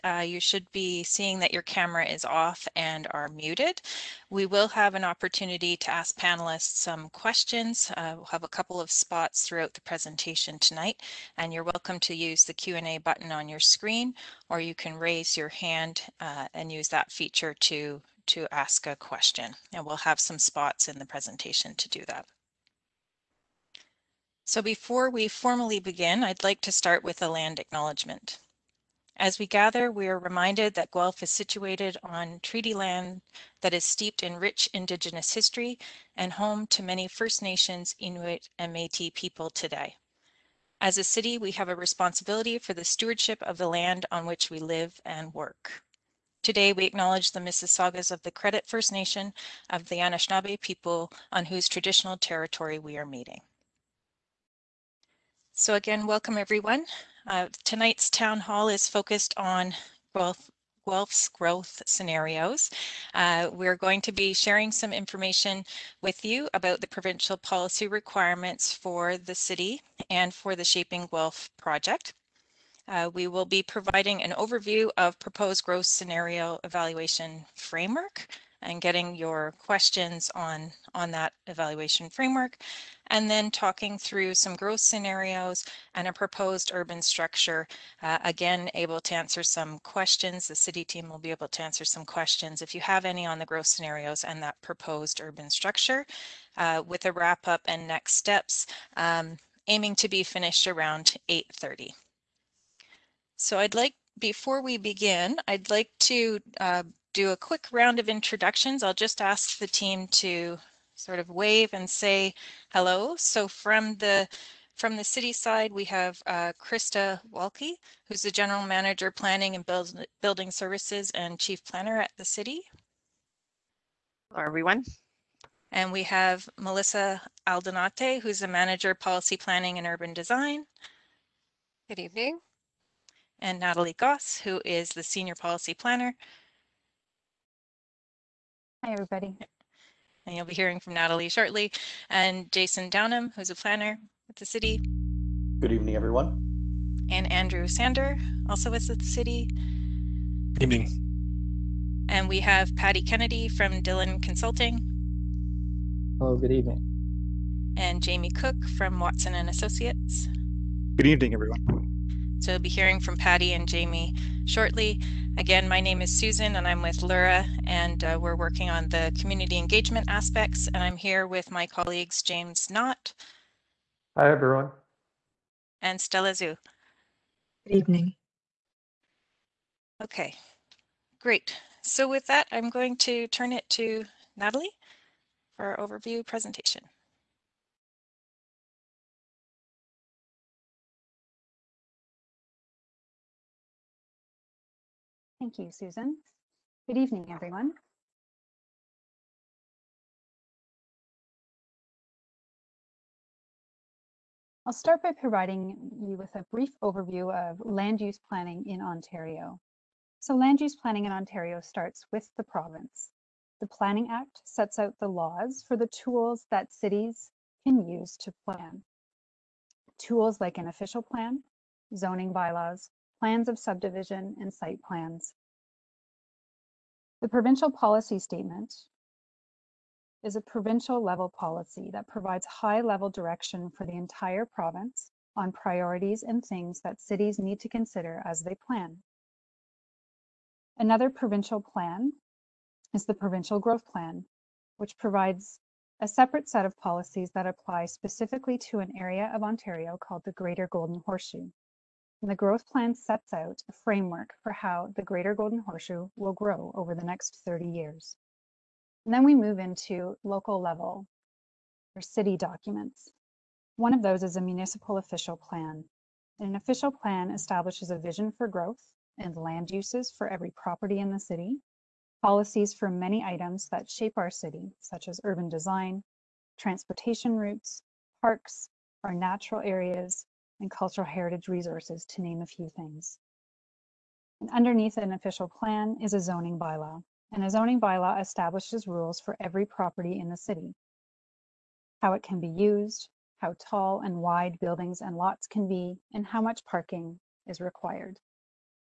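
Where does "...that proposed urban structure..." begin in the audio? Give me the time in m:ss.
1:34.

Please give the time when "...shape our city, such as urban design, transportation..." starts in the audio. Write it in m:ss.
4:33.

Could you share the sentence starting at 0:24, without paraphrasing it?
So before we formally begin, I'd like to start with a land acknowledgement.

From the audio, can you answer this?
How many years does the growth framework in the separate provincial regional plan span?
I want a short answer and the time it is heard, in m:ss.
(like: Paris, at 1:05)
30, at 4:17.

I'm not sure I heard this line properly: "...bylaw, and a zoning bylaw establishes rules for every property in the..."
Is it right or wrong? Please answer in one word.
right.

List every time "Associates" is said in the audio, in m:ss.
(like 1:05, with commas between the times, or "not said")
2:39.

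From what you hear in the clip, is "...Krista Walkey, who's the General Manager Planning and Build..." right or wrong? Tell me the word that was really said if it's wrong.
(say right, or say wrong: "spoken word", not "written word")
right.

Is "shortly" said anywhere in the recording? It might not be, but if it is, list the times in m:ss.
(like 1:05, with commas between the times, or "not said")
2:21, 2:44.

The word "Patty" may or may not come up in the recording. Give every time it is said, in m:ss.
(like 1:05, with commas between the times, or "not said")
2:32, 2:43.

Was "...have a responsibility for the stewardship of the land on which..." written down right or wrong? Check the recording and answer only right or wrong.
right.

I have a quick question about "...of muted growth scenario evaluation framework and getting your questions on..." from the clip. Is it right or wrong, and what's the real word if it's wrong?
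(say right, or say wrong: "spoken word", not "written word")
wrong: "proposed", not "muted".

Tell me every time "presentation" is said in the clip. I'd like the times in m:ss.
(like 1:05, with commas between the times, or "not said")
0:09, 0:21, 3:06.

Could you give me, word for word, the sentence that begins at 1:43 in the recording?
So I'd like, before we begin, I'd like to uh, do a quick round of introductions.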